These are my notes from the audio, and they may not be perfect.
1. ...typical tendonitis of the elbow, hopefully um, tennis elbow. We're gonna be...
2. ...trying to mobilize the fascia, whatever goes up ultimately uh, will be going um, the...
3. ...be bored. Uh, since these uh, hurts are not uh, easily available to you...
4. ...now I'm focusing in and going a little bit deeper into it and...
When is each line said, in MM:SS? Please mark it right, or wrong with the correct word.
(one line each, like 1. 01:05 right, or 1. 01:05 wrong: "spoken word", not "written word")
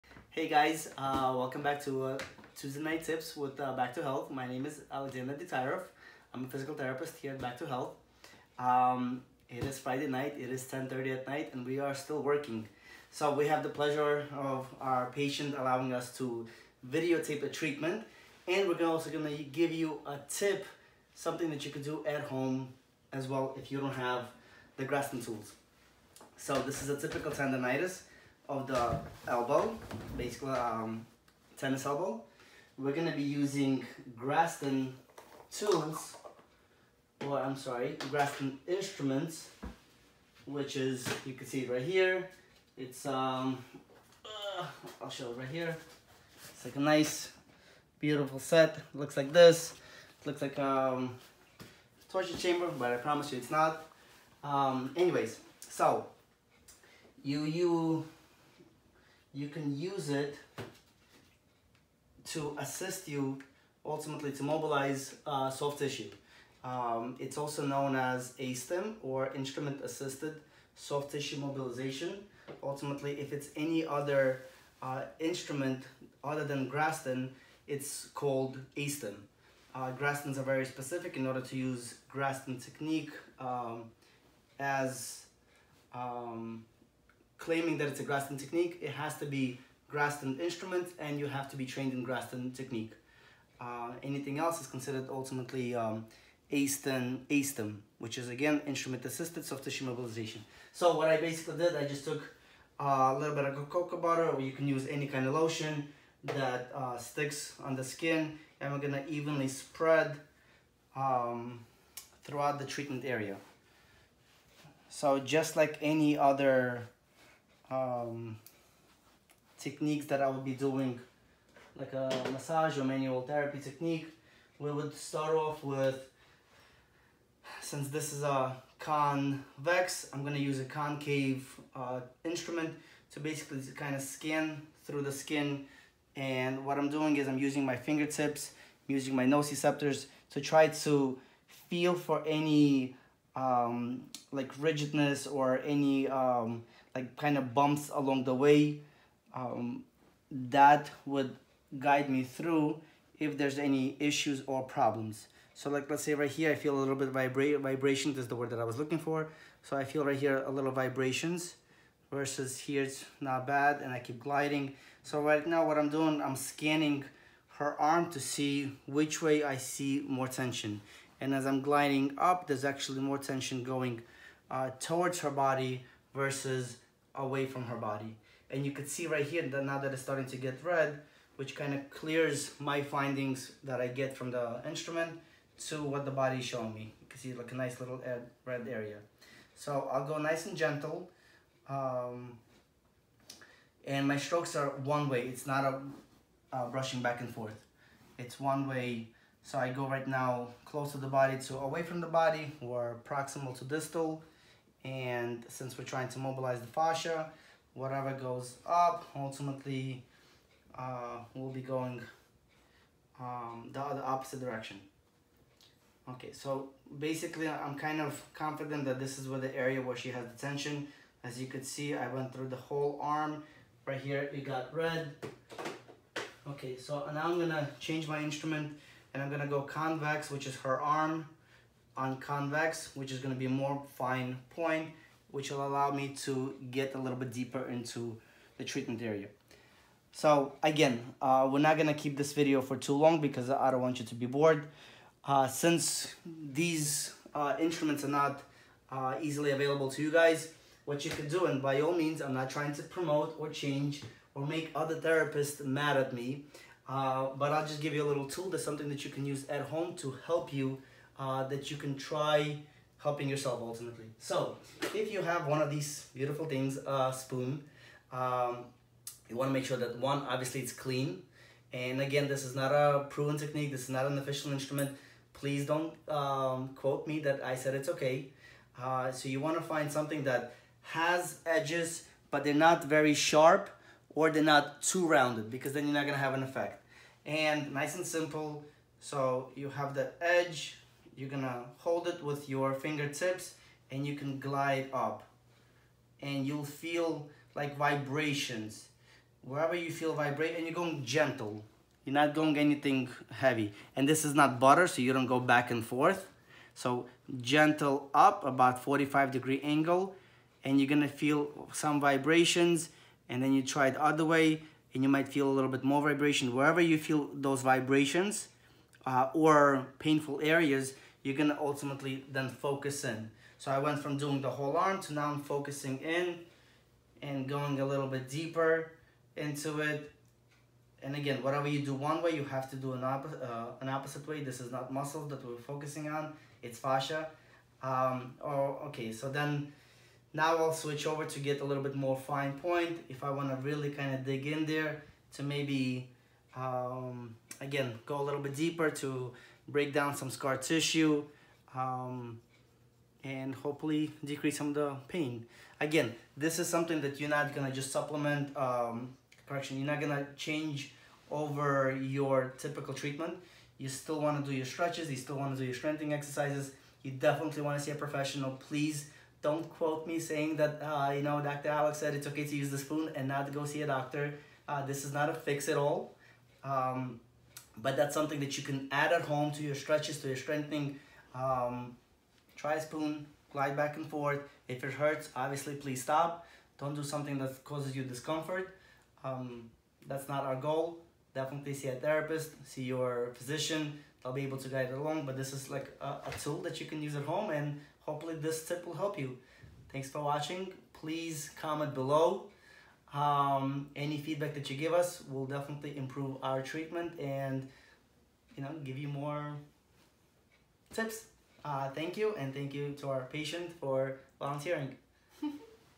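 1. 00:26 wrong: "basically", not "hopefully"
2. 03:25 right
3. 04:04 wrong: "instruments", not "hurts"
4. 05:25 right.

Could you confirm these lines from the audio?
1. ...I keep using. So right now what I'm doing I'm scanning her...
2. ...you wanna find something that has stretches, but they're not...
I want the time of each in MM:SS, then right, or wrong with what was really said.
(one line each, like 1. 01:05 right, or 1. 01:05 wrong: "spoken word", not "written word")
1. 02:43 wrong: "gliding", not "using"
2. 04:39 wrong: "edges", not "stretches".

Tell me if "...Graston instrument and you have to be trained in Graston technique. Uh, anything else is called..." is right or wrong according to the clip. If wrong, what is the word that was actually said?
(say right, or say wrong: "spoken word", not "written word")
wrong: "considered", not "called".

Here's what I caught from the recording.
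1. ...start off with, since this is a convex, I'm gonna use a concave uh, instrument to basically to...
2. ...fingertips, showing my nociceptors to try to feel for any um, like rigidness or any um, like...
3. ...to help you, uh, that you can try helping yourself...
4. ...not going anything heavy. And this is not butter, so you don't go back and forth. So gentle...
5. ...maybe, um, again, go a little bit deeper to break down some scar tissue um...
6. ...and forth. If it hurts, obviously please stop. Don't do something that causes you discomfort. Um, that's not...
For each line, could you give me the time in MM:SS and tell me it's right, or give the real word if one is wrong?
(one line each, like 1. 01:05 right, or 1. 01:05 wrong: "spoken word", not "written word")
1. 02:04 right
2. 02:17 wrong: "using", not "showing"
3. 04:19 right
4. 05:02 right
5. 05:45 right
6. 06:23 right.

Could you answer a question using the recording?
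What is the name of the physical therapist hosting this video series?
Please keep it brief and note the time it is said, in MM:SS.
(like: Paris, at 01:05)
Aleksandr Dekhtyarev, at 00:04.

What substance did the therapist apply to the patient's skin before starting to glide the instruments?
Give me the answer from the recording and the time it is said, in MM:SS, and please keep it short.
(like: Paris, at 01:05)
cocoa butter, at 01:43.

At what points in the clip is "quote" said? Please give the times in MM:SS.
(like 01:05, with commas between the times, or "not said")
04:36, 06:09.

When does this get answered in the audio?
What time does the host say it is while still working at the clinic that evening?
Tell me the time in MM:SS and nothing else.
00:10.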